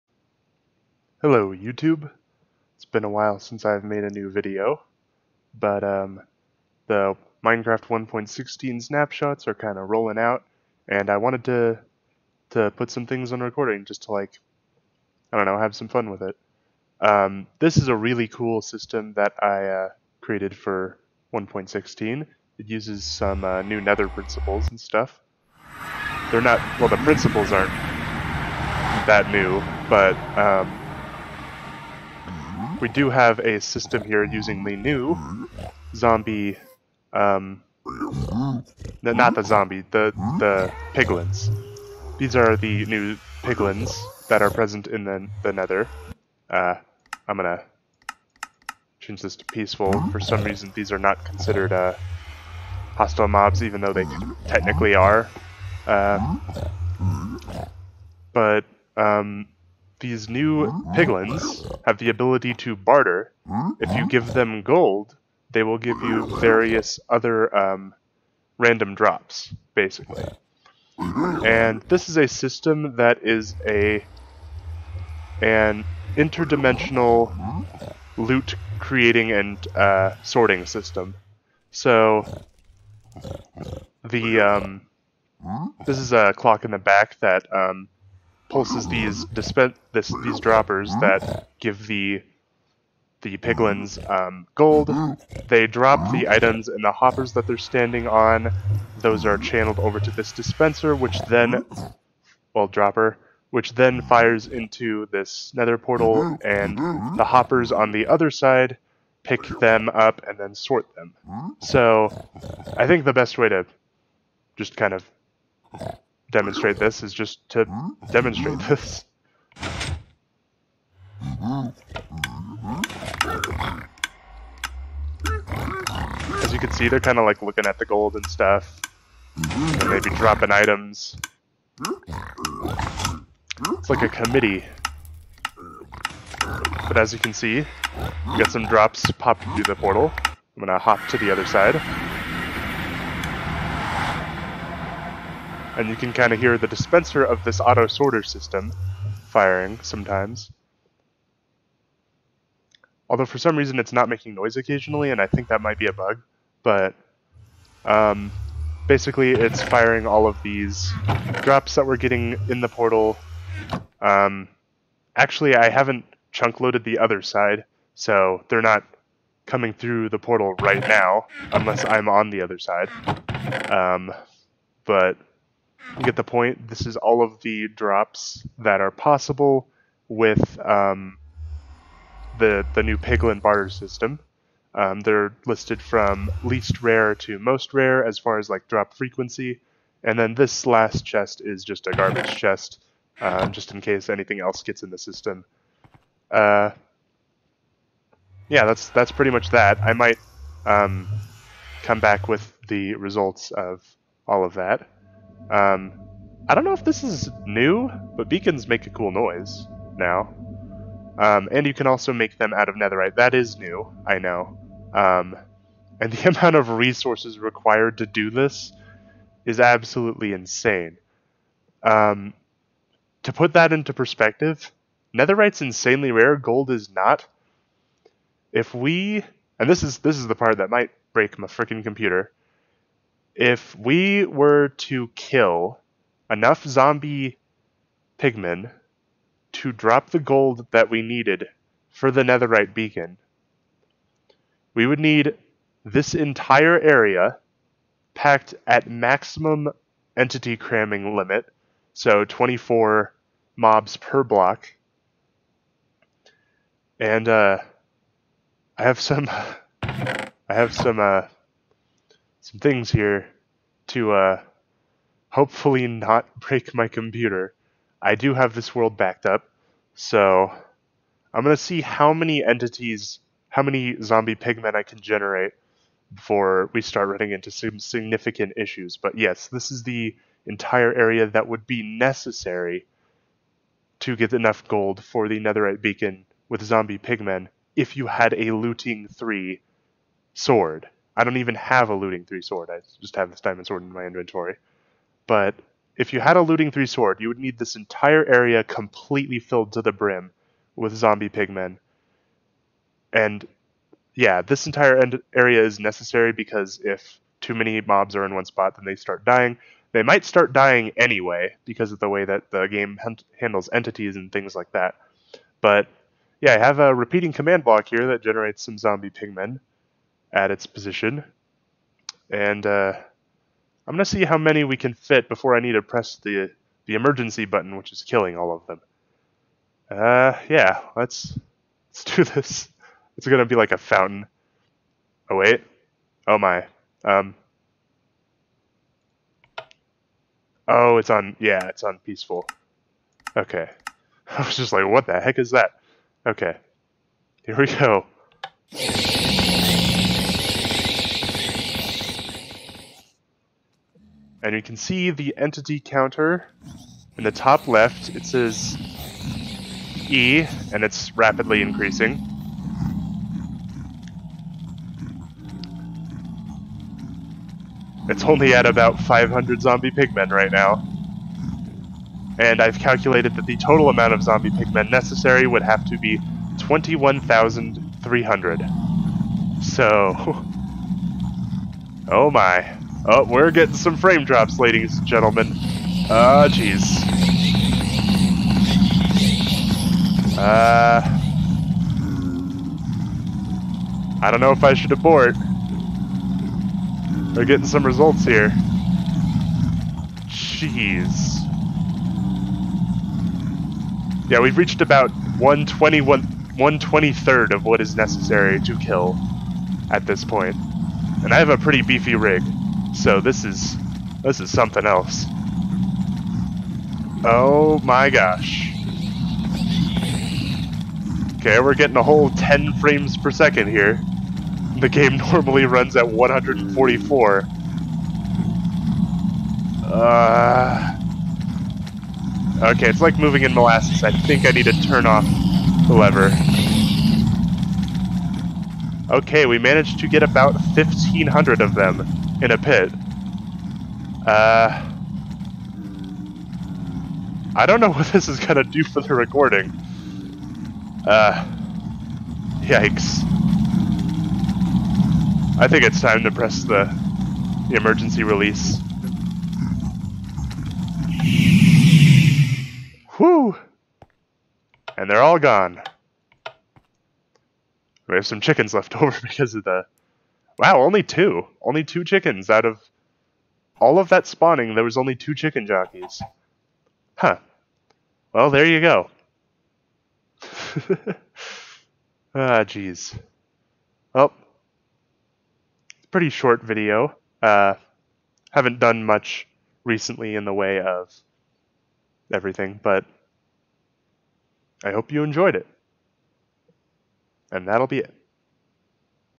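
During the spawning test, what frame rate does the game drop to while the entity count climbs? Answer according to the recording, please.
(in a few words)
10 frames per second.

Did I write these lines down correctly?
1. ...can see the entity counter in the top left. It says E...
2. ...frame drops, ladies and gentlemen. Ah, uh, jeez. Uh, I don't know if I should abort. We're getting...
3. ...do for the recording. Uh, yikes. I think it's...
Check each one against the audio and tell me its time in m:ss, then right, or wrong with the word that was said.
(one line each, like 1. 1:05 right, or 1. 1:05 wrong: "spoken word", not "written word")
1. 5:54 right
2. 6:23 right
3. 7:28 right.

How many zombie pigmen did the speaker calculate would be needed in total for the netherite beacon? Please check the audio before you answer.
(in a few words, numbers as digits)
21,300.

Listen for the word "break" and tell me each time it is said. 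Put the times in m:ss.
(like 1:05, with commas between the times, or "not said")
3:51, 4:26.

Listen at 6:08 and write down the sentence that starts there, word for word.
It's only at about 500 zombie pigmen right now.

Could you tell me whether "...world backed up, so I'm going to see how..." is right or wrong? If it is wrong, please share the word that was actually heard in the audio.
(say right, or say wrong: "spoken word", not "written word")
right.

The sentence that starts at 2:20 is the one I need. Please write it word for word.
I'm gonna hop to the other side.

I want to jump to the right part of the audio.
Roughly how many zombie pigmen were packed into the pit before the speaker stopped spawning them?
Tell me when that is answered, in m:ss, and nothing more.
7:20.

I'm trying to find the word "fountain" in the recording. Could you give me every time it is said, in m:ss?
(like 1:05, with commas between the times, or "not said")
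5:33.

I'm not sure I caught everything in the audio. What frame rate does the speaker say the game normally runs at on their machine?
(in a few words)
144.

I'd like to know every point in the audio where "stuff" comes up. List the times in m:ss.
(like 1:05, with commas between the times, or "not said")
0:24, 2:08.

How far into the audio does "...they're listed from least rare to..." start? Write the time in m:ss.
3:05.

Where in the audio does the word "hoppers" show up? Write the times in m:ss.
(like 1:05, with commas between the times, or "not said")
1:36, 1:47.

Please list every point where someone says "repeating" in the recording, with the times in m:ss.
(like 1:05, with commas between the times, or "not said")
5:16.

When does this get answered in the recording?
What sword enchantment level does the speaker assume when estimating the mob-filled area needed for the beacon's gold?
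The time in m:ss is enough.
4:48.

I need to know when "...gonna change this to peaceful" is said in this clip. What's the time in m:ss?
0:47.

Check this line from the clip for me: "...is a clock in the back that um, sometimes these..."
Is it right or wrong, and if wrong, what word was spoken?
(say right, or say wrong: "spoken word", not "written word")
wrong: "pulses", not "sometimes".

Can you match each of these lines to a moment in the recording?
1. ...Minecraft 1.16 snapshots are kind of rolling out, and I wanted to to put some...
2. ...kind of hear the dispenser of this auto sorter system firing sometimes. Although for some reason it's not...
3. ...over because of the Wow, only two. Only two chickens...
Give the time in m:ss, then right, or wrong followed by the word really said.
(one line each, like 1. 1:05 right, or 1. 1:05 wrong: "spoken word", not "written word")
1. 0:07 right
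2. 2:26 right
3. 7:48 right.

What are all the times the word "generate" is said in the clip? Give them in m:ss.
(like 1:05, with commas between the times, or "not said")
4:34, 5:18.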